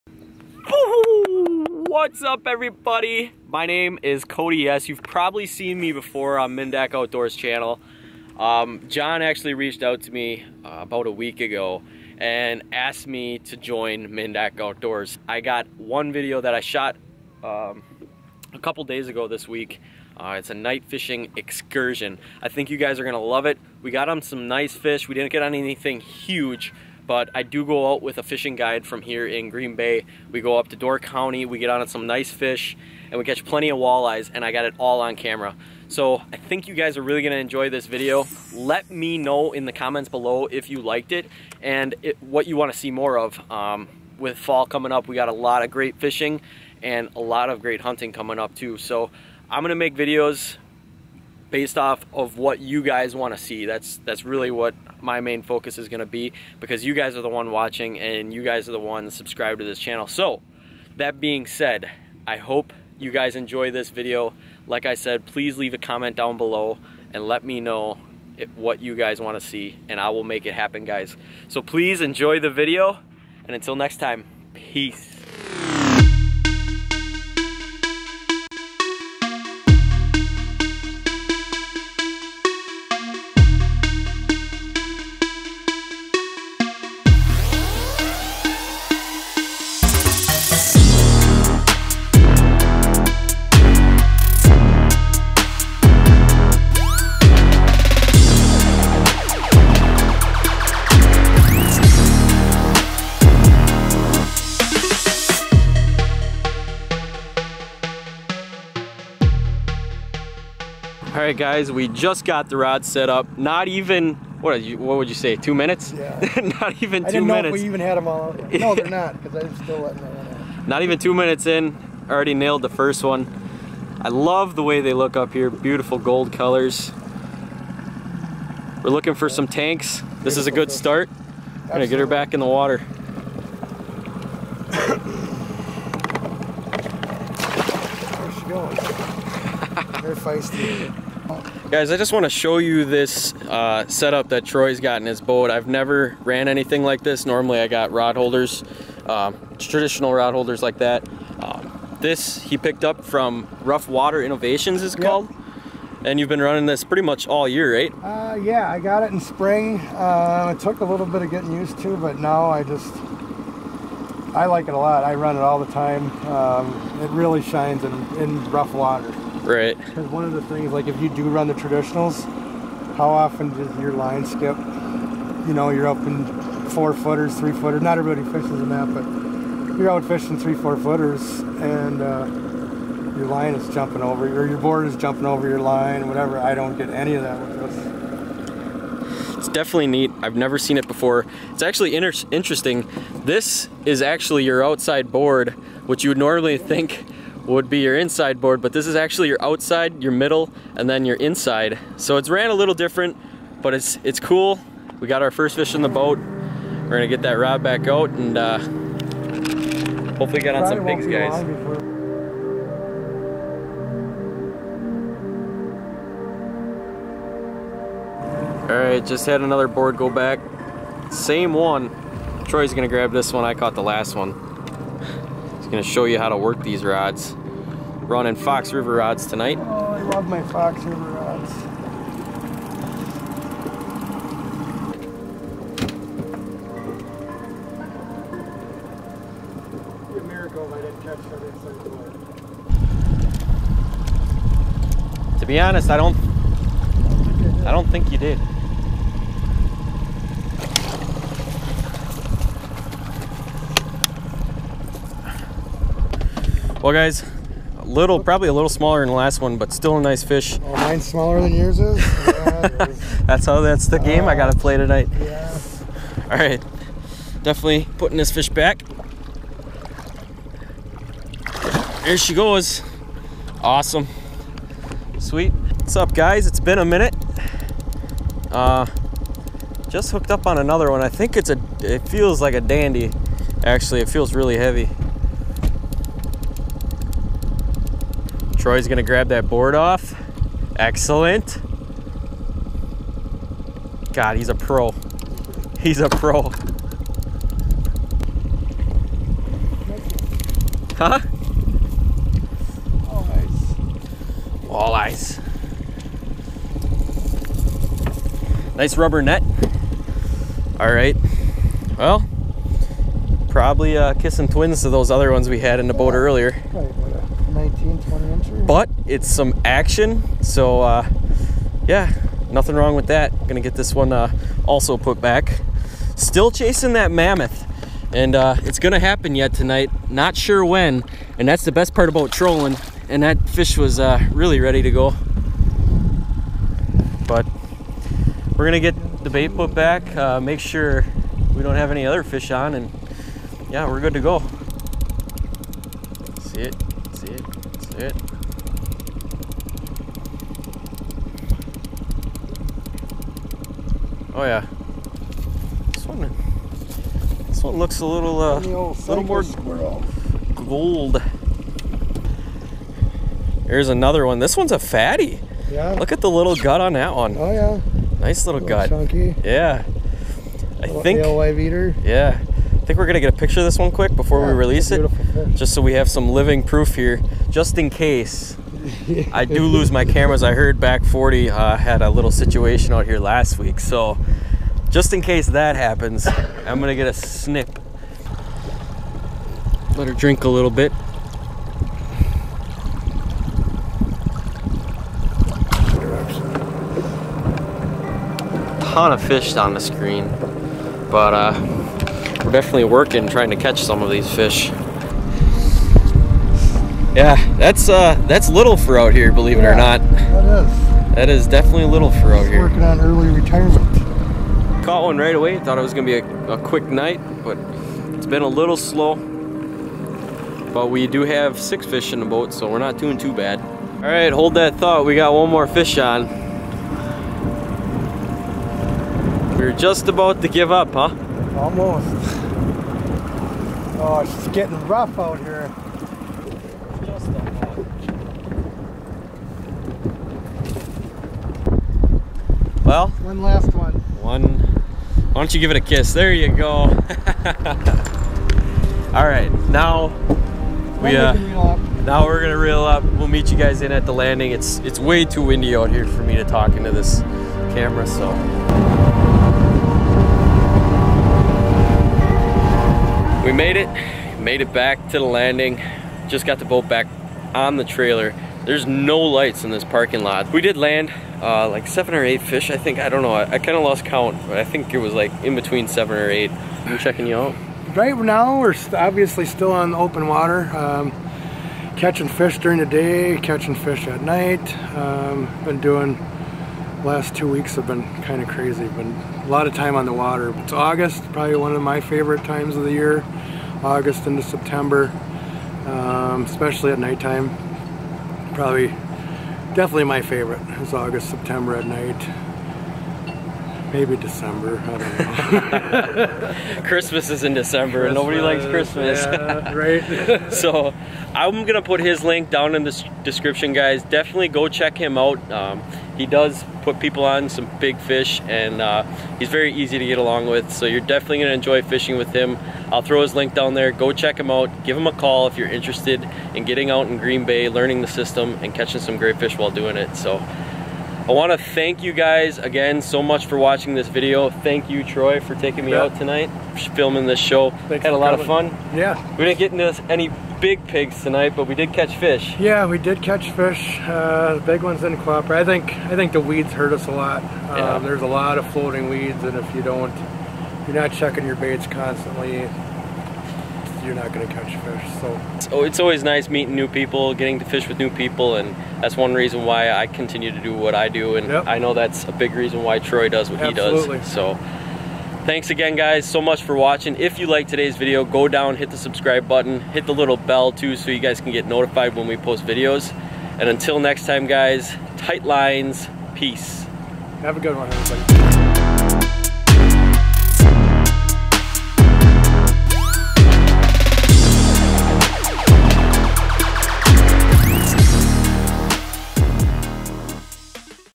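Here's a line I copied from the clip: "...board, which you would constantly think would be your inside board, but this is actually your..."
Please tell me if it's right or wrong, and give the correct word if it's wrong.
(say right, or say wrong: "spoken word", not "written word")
wrong: "normally", not "constantly".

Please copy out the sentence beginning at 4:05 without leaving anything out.
To be honest, I don't I don't think you did.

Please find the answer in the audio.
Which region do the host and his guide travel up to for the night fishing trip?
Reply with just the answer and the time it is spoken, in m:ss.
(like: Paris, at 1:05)
Door County, at 0:30.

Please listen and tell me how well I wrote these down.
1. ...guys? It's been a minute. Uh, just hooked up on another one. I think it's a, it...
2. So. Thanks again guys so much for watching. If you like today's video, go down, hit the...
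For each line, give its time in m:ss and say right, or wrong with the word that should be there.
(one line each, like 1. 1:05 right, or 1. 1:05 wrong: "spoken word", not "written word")
1. 4:36 right
2. 9:24 right.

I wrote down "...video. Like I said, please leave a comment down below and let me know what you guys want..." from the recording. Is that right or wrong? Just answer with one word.
right.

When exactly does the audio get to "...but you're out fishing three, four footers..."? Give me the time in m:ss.
2:58.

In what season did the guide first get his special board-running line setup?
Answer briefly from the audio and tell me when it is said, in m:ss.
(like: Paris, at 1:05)
spring, at 2:39.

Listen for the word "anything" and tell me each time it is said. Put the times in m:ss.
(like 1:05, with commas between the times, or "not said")
0:25, 2:26.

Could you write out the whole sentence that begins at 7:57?
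Right now, we're obviously still on open water.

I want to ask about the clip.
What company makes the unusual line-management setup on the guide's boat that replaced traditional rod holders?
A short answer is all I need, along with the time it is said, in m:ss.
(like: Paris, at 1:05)
Rough Water Innovations, at 2:33.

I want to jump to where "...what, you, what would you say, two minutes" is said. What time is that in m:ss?
1:54.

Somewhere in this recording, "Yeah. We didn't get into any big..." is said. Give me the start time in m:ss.
8:58.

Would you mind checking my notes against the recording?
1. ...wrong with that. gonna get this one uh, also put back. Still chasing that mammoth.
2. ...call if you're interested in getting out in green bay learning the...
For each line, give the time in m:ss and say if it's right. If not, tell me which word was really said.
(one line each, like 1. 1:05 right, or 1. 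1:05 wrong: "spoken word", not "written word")
1. 5:22 right
2. 8:45 right.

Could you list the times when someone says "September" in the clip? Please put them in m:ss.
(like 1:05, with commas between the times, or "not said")
8:14, 8:21.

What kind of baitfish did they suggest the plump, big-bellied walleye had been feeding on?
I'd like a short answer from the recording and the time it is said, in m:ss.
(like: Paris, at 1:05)
Alewife, at 6:11.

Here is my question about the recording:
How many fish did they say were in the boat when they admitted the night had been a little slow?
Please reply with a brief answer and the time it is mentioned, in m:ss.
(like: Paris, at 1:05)
6, at 7:01.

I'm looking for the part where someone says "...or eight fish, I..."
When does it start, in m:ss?
7:52.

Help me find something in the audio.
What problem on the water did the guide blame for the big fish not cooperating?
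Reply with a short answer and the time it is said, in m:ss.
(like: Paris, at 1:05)
floating weeds, at 9:08.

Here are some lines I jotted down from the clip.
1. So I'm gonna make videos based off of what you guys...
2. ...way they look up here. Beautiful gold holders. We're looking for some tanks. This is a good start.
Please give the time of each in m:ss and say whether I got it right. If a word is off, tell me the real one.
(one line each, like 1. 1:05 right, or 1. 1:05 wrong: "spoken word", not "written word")
1. 0:48 right
2. 2:04 wrong: "colors", not "holders".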